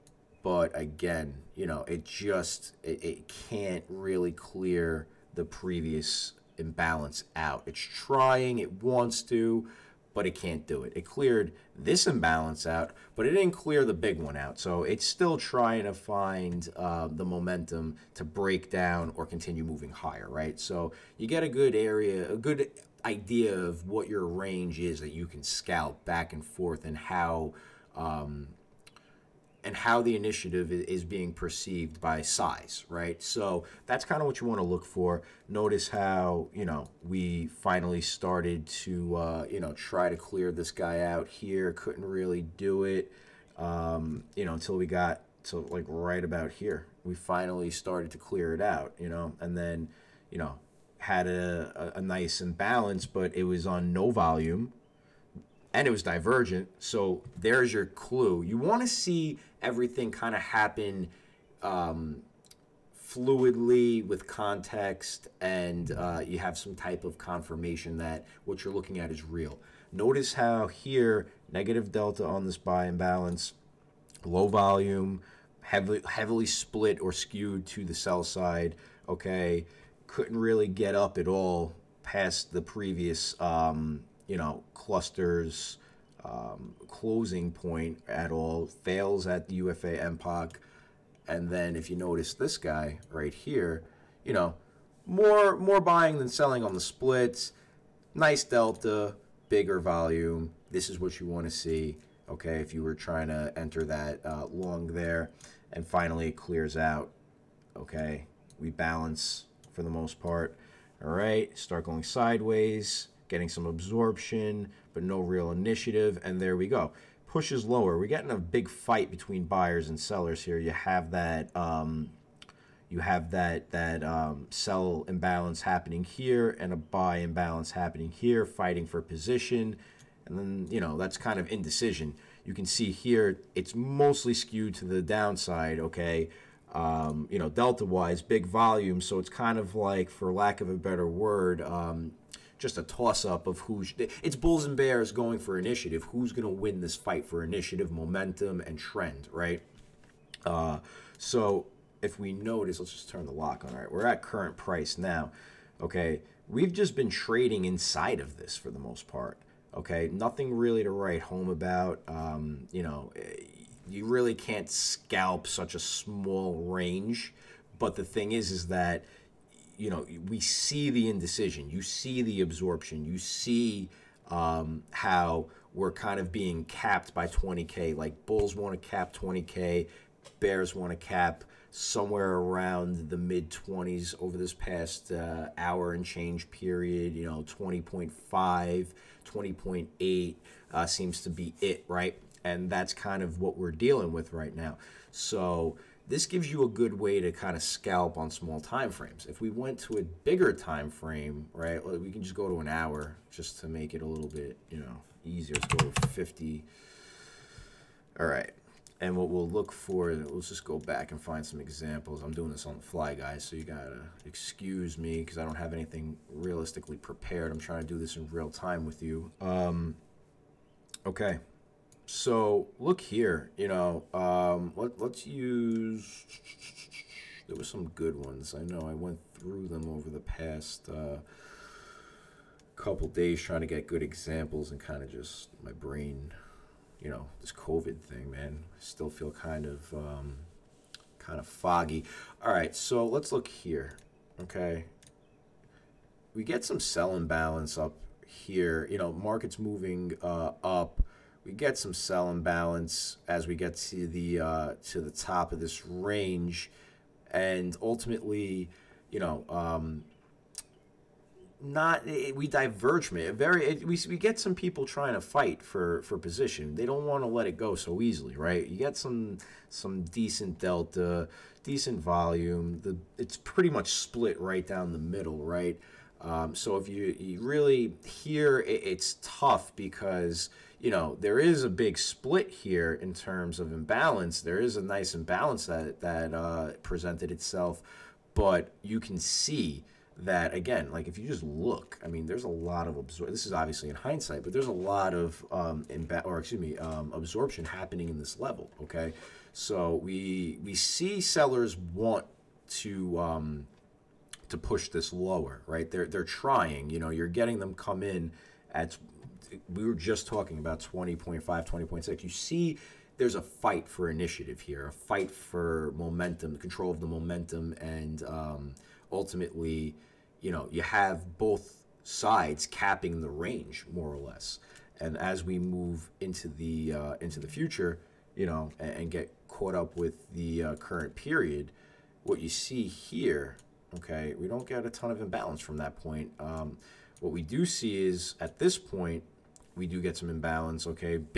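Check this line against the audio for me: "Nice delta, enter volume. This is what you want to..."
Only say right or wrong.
wrong.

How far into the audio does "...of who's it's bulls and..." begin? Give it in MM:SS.
02:23.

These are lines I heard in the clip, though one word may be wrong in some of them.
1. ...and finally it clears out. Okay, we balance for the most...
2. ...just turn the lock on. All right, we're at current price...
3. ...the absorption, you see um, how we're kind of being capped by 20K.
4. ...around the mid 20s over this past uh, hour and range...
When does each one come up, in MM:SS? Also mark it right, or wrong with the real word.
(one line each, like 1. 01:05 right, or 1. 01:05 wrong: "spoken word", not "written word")
1. 01:45 right
2. 02:32 right
3. 02:52 right
4. 03:02 wrong: "change", not "range".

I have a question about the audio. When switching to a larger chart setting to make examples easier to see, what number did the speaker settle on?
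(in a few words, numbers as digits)
50.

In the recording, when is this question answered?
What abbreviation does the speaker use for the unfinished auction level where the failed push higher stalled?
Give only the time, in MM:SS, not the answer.
01:29.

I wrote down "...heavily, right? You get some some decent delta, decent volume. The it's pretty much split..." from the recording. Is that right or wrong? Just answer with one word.
wrong.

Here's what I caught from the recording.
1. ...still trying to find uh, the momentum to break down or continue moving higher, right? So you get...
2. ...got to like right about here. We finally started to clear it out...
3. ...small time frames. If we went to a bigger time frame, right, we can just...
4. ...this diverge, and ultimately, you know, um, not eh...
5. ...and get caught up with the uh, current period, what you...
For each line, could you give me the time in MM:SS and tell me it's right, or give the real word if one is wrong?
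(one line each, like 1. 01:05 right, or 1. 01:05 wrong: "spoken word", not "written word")
1. 00:15 right
2. 00:44 right
3. 03:18 right
4. 04:15 wrong: "range", not "diverge"
5. 05:28 right.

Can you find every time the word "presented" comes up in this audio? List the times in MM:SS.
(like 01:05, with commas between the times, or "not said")
04:46.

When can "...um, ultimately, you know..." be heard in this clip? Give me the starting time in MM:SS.
05:18.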